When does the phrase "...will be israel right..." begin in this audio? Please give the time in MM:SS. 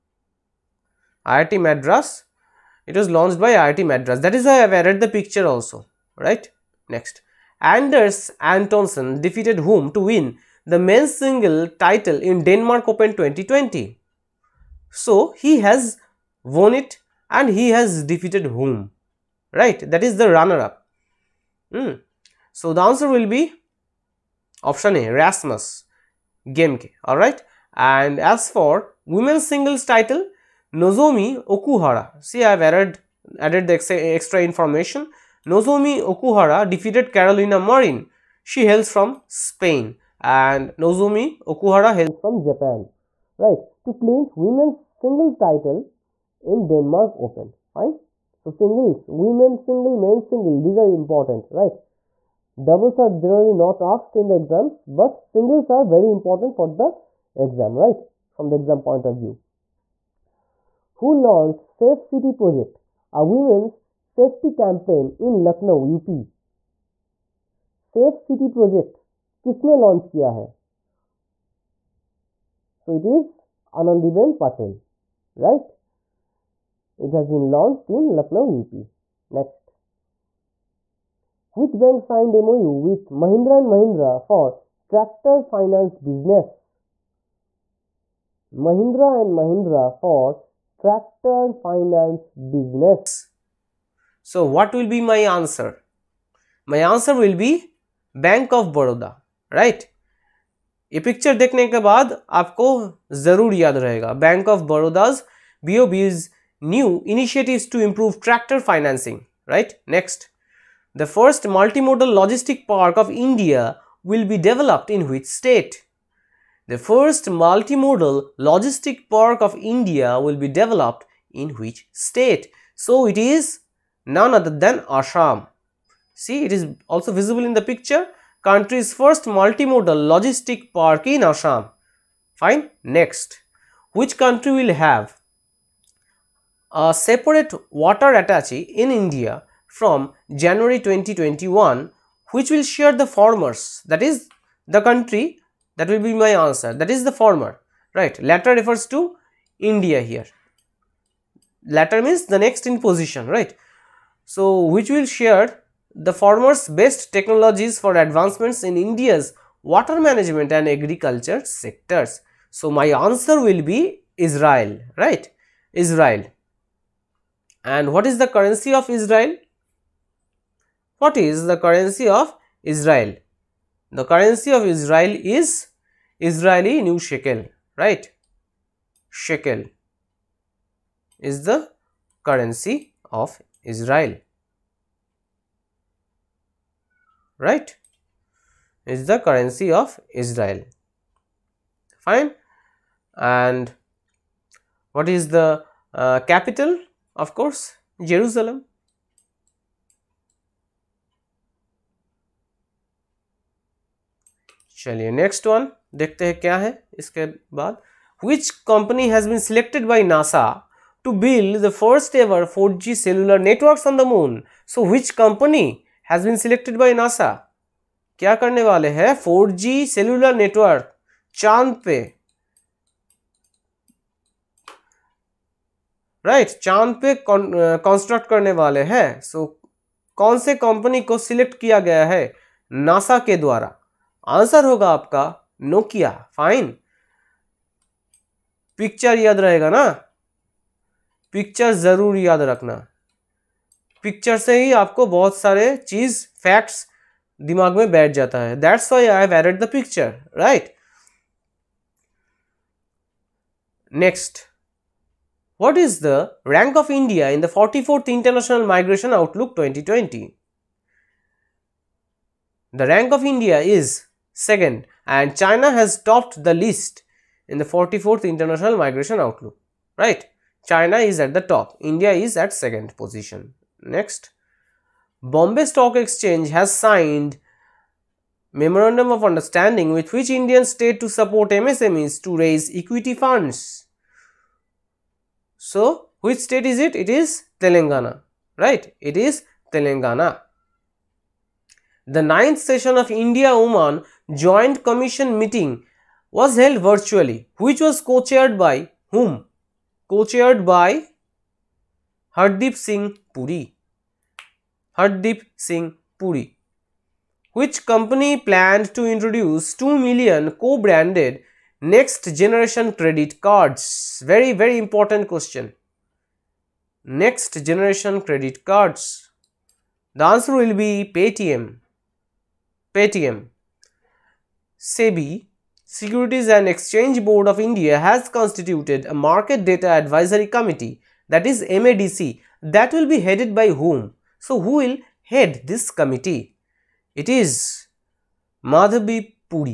02:43.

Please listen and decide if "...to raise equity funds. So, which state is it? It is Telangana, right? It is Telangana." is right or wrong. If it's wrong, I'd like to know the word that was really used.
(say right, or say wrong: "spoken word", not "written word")
right.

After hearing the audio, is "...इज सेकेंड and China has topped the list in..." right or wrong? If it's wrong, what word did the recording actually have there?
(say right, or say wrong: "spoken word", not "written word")
right.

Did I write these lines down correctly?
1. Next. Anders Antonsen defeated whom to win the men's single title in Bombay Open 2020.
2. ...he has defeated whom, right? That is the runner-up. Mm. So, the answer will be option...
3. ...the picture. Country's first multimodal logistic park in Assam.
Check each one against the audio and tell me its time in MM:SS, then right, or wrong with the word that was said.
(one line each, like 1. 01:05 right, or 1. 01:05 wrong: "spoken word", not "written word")
1. 00:06 wrong: "Denmark", not "Bombay"
2. 00:17 right
3. 02:07 right.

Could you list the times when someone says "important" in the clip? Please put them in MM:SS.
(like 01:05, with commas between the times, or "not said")
00:50, 00:56, 05:14.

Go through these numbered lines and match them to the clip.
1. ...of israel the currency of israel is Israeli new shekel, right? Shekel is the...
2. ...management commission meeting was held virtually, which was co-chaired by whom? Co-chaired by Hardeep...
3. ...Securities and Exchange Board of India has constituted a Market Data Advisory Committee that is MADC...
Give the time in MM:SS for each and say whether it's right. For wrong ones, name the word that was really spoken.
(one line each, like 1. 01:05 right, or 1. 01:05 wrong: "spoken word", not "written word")
1. 02:52 right
2. 04:54 wrong: "joint", not "management"
3. 05:25 right.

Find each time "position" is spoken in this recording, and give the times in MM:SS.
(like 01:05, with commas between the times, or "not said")
02:32, 04:32.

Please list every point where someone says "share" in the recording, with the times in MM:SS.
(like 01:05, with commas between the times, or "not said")
02:22, 02:35.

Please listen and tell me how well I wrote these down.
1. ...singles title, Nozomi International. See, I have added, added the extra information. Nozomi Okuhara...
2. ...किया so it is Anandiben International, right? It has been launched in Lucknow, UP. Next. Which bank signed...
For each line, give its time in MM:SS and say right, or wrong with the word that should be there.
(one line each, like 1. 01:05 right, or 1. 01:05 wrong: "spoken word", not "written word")
1. 00:29 wrong: "Okuhara", not "International"
2. 01:10 wrong: "Patel", not "International".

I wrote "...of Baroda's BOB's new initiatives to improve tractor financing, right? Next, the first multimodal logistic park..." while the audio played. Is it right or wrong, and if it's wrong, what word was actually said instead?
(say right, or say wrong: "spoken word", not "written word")
right.